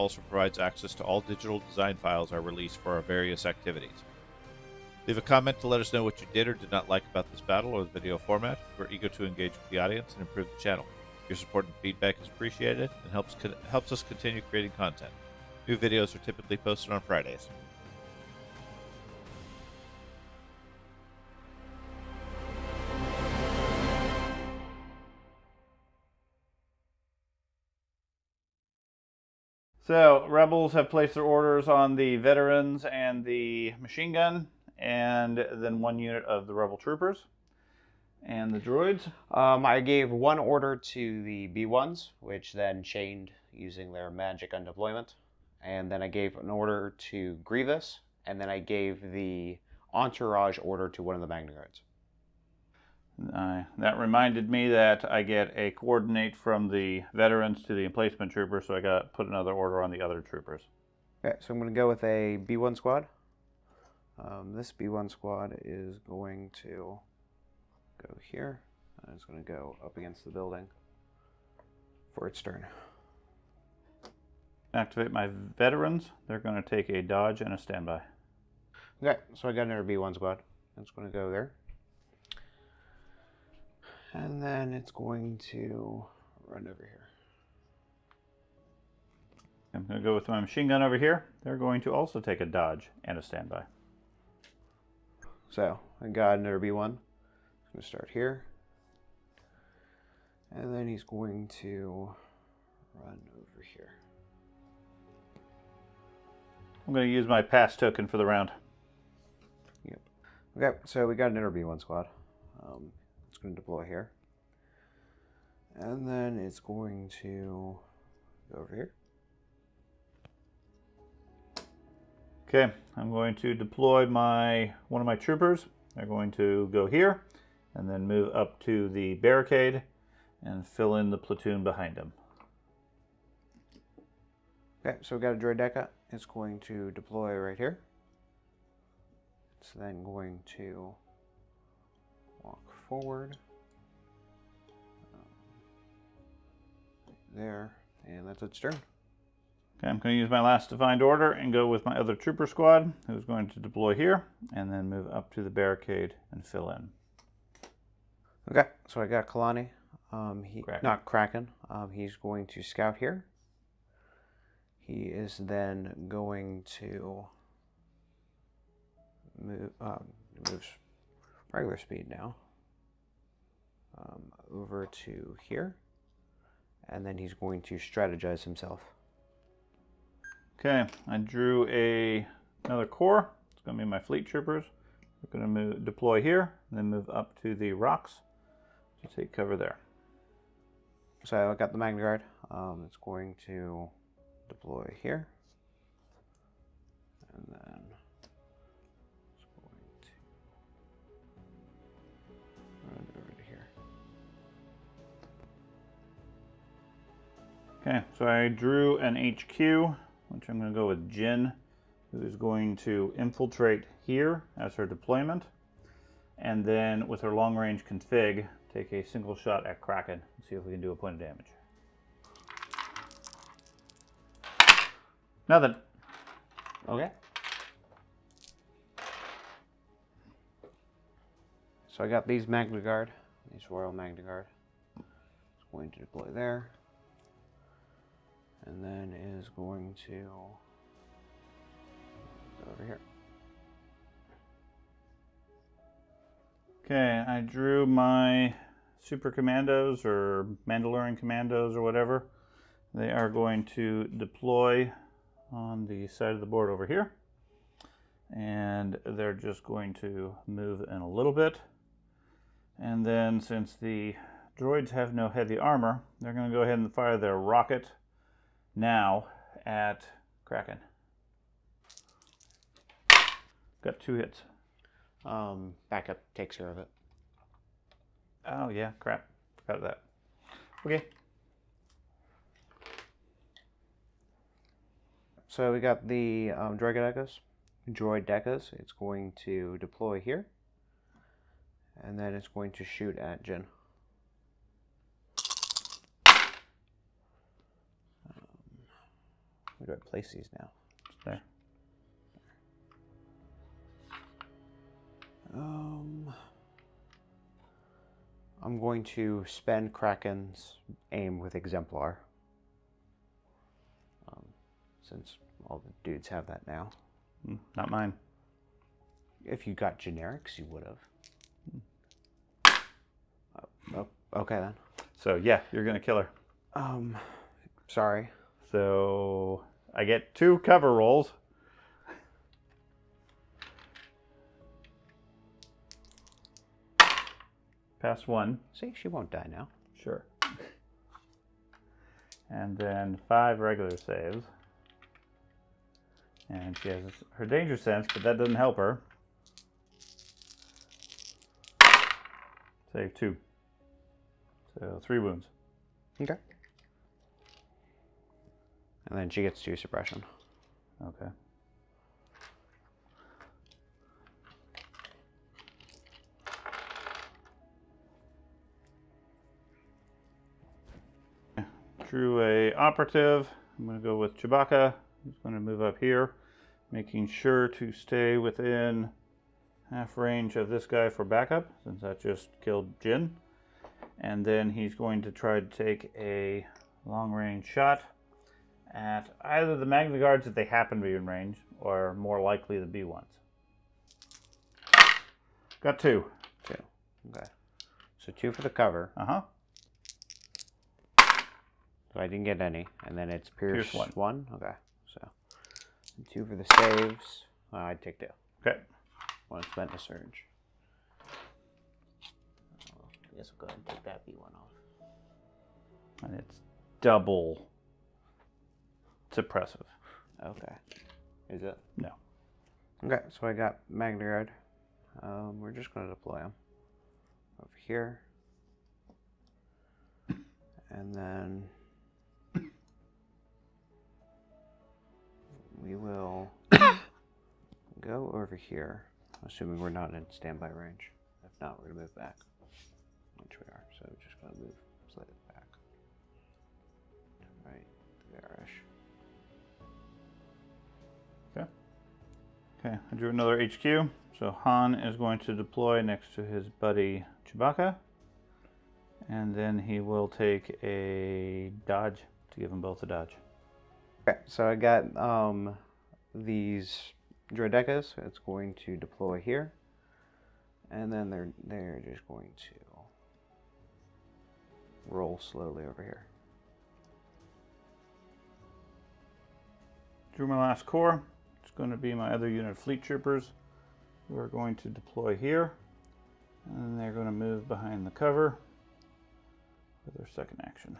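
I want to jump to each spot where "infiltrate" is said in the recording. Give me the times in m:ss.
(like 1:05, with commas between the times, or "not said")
3:33.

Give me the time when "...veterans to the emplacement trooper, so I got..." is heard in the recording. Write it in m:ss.
0:57.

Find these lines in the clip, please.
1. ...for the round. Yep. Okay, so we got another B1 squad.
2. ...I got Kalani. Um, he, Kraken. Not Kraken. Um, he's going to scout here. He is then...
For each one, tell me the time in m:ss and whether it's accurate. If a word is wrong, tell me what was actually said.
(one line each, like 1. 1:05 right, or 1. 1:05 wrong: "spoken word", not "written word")
1. 1:48 right
2. 2:38 right.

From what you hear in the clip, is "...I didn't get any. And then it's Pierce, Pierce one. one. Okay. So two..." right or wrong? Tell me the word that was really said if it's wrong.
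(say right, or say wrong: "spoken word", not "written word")
right.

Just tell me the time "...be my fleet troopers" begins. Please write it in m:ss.
3:03.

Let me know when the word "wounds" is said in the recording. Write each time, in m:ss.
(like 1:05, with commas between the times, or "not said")
5:55.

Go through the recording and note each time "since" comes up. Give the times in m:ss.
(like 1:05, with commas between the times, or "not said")
4:23, 5:15, 6:21.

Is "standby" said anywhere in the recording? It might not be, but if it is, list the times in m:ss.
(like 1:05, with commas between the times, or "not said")
1:17, 1:33, 7:20.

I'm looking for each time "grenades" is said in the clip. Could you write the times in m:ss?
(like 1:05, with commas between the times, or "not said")
not said.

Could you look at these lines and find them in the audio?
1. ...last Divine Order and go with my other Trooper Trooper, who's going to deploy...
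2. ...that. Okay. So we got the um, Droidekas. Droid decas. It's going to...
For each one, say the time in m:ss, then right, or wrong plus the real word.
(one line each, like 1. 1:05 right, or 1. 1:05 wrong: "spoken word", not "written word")
1. 2:30 wrong: "Squad", not "Trooper"
2. 4:39 right.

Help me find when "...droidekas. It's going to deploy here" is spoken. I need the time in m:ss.
7:47.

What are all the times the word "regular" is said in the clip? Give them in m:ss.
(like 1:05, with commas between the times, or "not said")
2:51, 5:43.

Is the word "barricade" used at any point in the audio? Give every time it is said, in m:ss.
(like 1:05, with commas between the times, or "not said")
2:09, 2:35.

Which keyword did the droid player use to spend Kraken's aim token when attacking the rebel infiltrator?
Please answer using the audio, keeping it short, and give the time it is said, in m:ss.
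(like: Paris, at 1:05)
Exemplar, at 5:11.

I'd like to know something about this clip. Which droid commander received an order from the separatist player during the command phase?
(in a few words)
Grievous.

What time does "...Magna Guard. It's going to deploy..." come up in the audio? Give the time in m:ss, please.
3:53.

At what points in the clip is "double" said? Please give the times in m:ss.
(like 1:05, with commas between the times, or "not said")
6:56.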